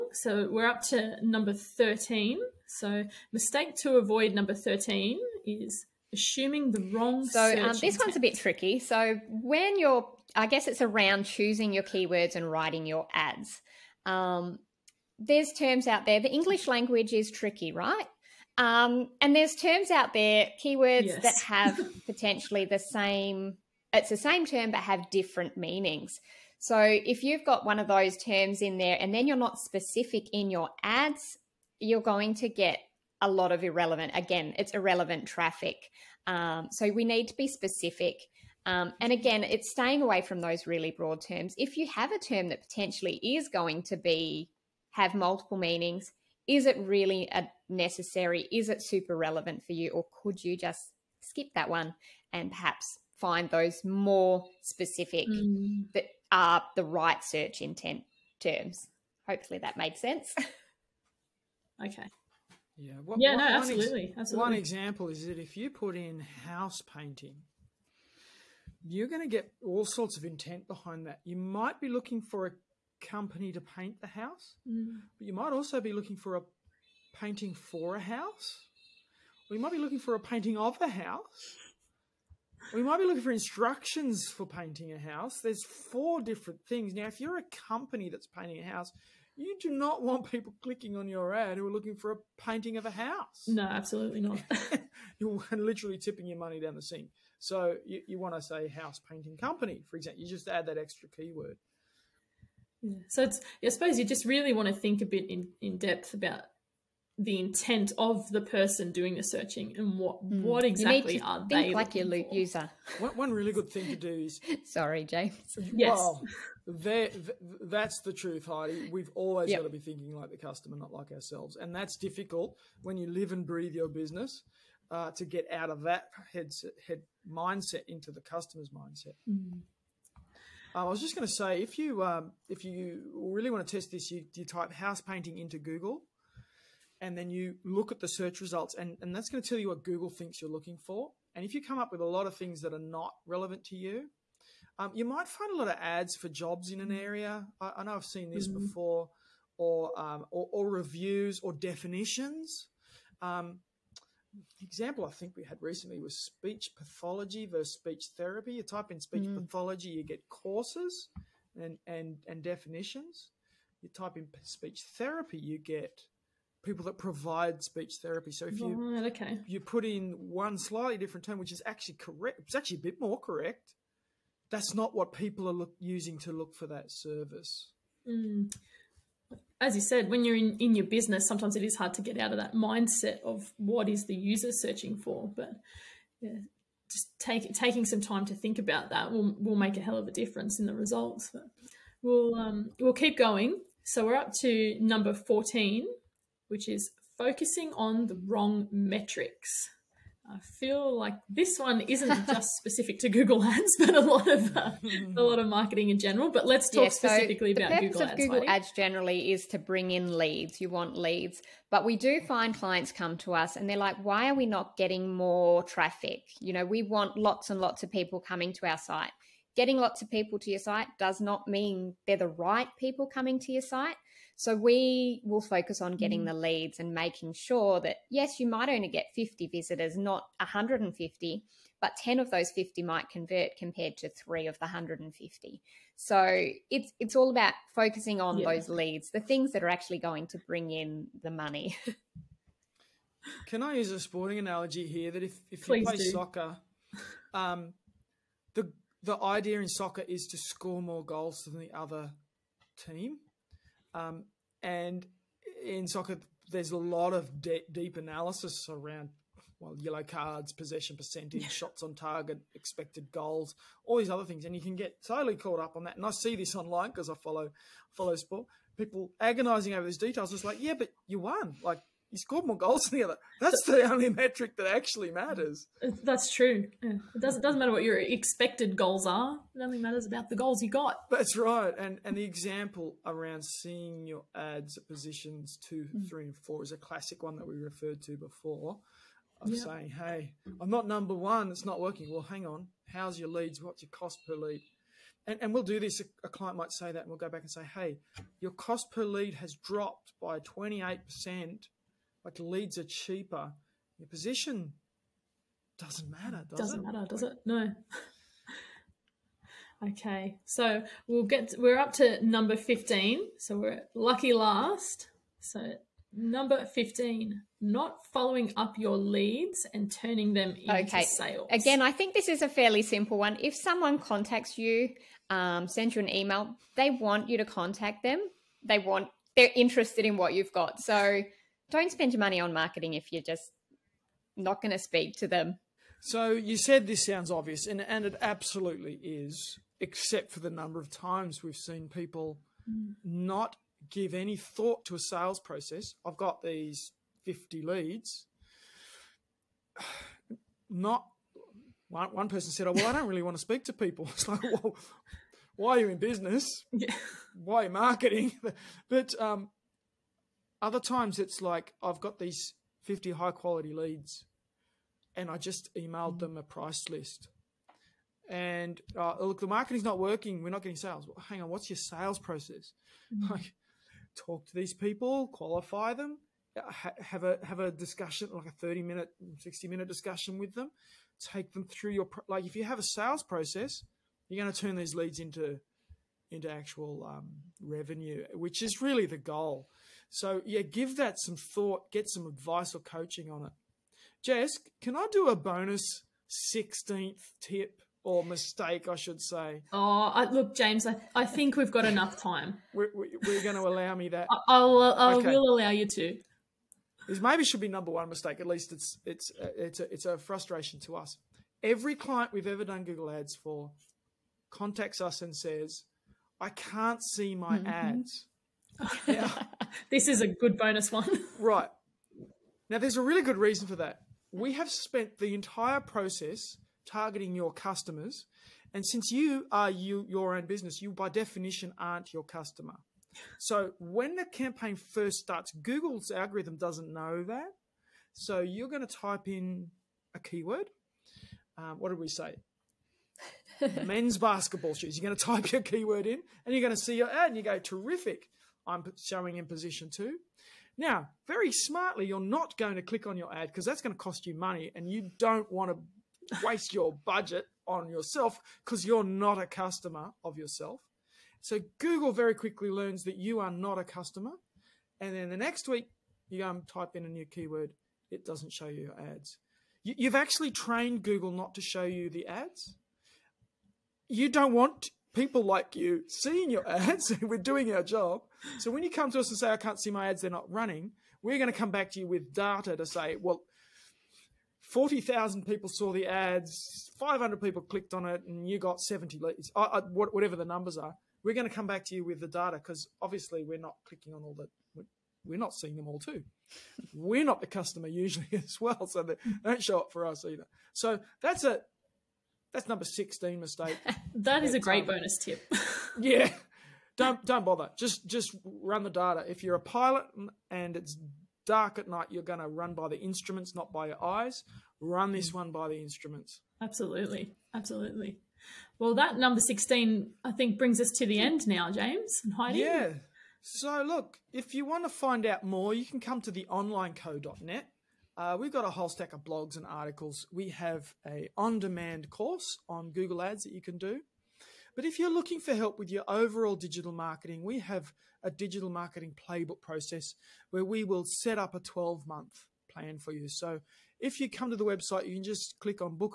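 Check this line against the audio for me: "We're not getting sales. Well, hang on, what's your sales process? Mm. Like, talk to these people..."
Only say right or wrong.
right.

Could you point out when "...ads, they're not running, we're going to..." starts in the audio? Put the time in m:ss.
8:00.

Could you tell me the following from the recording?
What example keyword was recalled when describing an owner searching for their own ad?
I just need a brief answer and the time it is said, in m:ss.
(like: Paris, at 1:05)
men's basketball shoes, at 7:23.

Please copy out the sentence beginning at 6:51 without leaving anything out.
Every client we've ever done Google Ads for contacts us and says, I can't see my mm -hmm.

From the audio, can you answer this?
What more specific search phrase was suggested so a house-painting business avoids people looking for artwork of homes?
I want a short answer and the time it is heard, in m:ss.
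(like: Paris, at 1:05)
house painting company, at 1:38.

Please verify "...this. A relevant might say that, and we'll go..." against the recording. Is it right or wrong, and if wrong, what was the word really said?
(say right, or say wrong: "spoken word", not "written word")
wrong: "client", not "relevant".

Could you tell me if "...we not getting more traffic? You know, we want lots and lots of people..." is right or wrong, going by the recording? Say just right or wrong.
right.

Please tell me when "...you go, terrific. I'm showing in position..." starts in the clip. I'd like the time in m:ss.
7:27.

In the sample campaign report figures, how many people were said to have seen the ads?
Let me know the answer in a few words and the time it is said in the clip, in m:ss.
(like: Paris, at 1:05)
40,000, at 8:04.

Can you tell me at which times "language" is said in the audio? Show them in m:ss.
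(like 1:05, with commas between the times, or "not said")
0:16.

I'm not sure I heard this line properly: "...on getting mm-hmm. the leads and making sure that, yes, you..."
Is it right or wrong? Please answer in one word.
right.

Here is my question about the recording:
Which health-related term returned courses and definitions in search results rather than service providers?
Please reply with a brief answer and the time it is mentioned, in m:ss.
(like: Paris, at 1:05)
speech pathology, at 2:36.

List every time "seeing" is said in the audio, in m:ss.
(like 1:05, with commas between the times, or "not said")
4:43, 7:56, 8:15.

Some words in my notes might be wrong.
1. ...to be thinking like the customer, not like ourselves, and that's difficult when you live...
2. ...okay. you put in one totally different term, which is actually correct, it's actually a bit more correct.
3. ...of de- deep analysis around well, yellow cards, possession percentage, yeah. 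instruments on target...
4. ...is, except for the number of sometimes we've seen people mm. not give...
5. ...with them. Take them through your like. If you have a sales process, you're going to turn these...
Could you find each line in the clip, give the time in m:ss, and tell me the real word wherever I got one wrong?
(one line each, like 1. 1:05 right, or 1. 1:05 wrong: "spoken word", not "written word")
1. 1:59 right
2. 2:49 wrong: "slightly", not "totally"
3. 4:17 wrong: "shots", not "instruments"
4. 5:39 wrong: "times", not "sometimes"
5. 6:20 right.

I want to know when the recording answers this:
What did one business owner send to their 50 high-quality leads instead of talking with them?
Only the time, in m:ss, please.
6:06.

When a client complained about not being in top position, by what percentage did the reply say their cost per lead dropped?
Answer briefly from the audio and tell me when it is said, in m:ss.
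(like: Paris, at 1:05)
28 percent, at 5:00.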